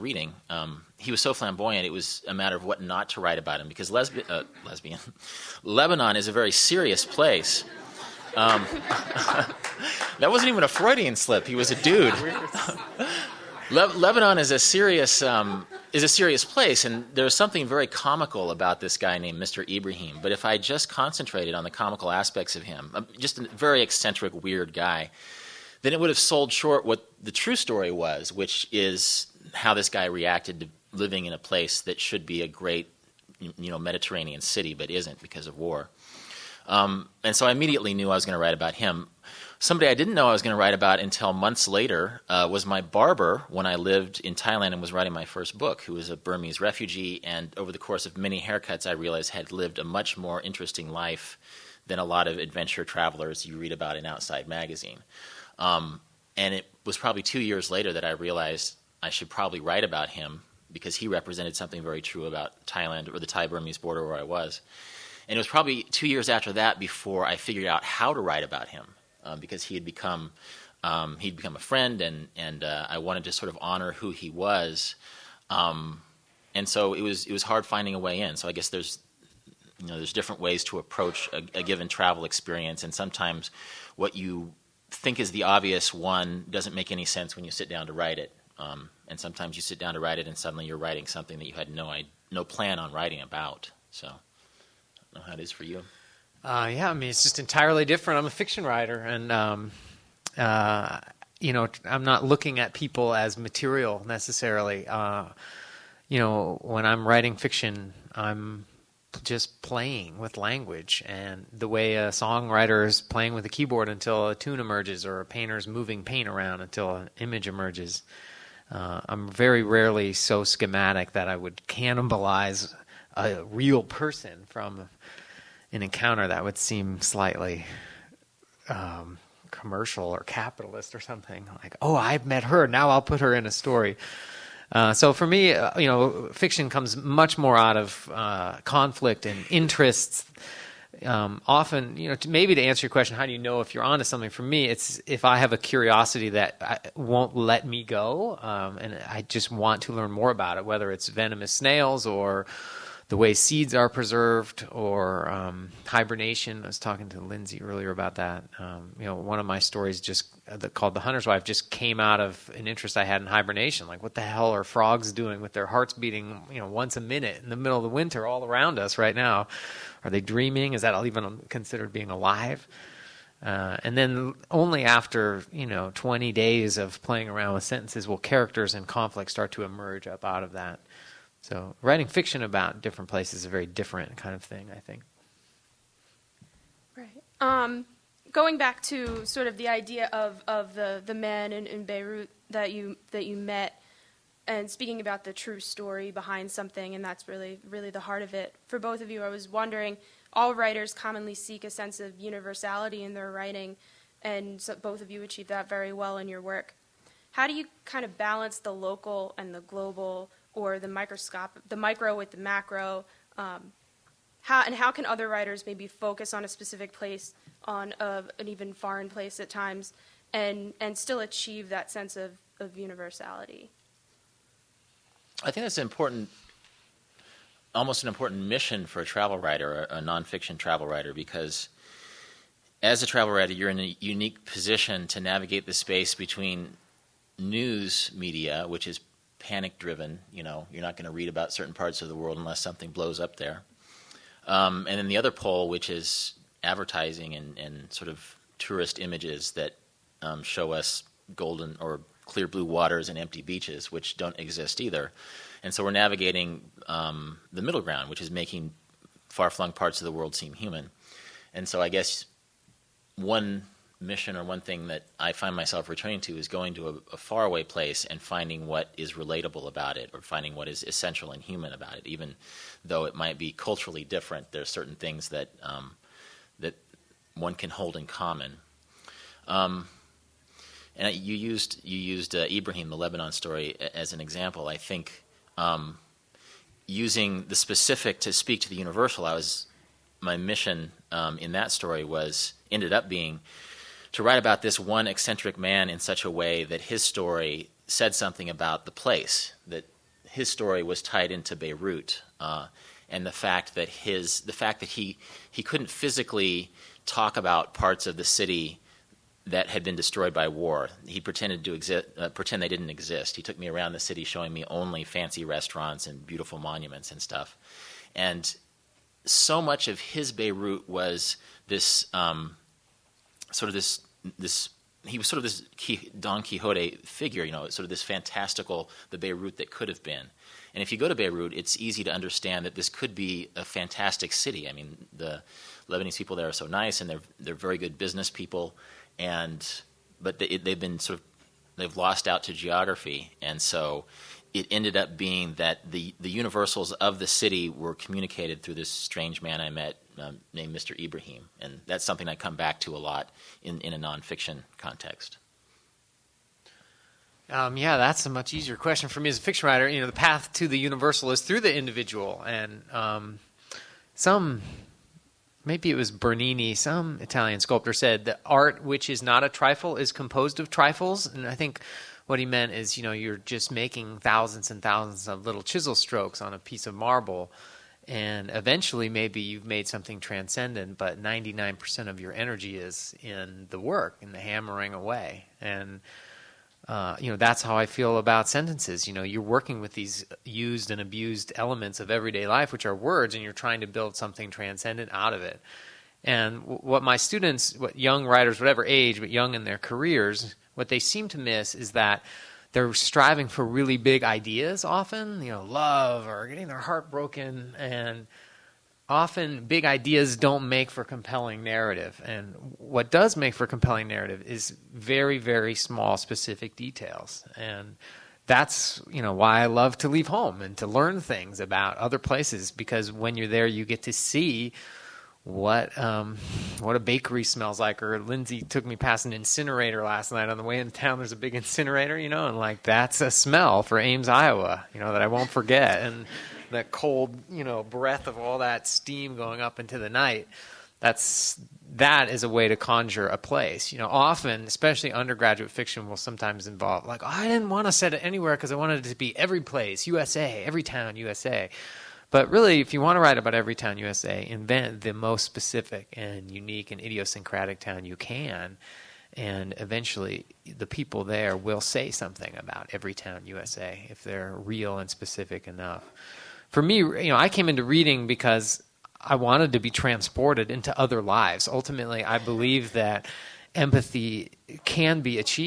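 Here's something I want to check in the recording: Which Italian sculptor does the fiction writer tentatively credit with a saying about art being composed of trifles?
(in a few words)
Bernini.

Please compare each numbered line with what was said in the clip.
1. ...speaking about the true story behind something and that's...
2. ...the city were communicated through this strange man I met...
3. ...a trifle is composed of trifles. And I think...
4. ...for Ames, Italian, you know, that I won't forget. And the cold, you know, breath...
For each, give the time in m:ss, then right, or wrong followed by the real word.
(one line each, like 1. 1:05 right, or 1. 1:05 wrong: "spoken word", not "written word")
1. 3:14 right
2. 5:47 right
3. 6:09 right
4. 7:13 wrong: "Iowa", not "Italian".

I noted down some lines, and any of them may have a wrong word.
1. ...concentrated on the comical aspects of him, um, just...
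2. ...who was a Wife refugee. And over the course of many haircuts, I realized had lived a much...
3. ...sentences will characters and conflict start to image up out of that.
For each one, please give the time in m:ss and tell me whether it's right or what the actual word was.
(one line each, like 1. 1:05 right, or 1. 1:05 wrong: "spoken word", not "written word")
1. 0:20 right
2. 0:45 wrong: "Burmese", not "Wife"
3. 2:57 wrong: "emerge", not "image".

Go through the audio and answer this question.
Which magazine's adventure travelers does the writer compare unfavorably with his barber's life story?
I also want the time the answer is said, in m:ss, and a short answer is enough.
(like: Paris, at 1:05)
Outside Magazine, at 0:54.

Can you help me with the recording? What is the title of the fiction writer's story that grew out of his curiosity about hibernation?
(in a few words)
The Hunter's Wife.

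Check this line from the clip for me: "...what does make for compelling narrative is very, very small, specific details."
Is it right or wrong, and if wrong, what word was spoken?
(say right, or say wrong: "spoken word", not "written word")
right.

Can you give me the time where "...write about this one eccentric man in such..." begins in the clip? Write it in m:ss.
4:54.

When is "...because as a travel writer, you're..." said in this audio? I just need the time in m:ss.
3:51.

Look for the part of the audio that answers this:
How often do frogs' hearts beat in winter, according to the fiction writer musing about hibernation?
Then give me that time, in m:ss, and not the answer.
2:46.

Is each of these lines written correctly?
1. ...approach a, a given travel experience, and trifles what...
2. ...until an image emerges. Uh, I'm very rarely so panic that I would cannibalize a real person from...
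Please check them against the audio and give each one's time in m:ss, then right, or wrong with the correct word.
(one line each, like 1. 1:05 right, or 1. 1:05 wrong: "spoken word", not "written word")
1. 1:20 wrong: "sometimes", not "trifles"
2. 1:56 wrong: "schematic", not "panic".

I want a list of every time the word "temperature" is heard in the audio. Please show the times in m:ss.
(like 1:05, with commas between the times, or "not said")
not said.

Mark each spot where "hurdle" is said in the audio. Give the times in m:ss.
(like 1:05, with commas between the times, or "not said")
not said.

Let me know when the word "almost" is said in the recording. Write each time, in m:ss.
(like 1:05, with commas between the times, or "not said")
3:47.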